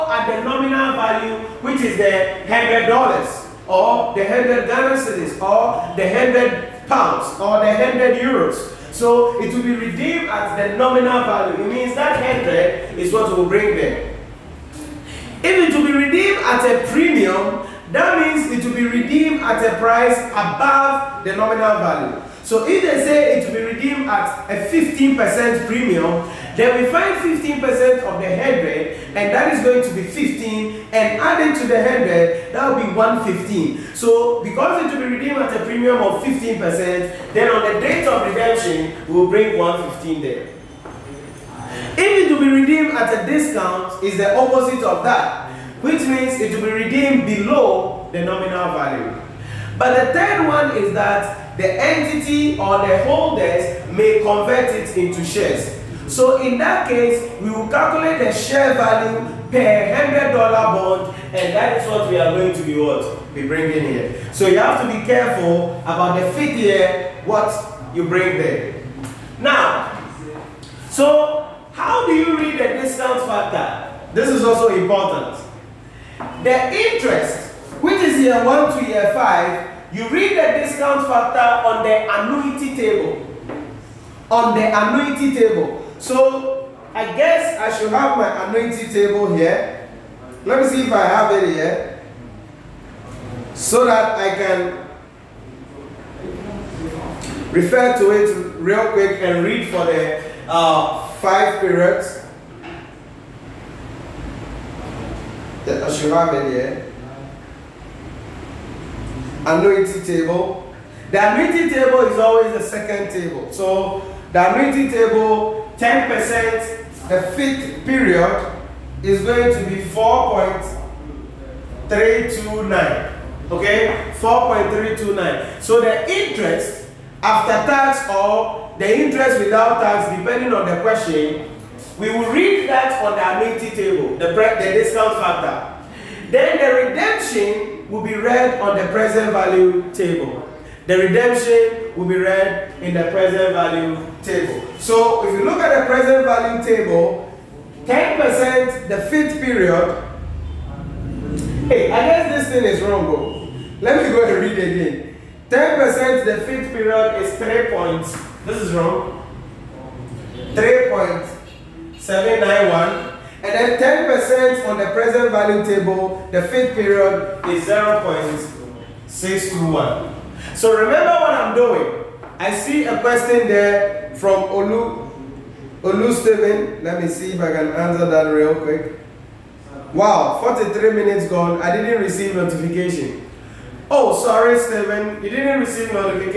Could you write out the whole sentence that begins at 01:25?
So I guess I should have my annuity table here.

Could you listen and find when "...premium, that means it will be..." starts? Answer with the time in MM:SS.
00:16.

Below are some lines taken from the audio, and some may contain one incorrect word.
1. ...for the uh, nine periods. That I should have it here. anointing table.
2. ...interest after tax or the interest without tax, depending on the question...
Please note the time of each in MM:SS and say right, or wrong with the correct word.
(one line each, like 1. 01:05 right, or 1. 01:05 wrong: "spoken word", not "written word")
1. 01:39 wrong: "five", not "nine"
2. 02:06 right.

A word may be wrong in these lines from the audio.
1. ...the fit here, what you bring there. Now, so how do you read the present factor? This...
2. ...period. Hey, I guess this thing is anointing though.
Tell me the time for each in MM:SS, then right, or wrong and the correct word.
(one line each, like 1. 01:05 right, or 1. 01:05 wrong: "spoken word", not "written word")
1. 01:06 wrong: "discount", not "present"
2. 02:29 wrong: "wrong", not "anointing".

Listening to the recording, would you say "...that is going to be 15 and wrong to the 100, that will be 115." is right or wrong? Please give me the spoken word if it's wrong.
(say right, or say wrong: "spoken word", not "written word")
wrong: "adding", not "wrong".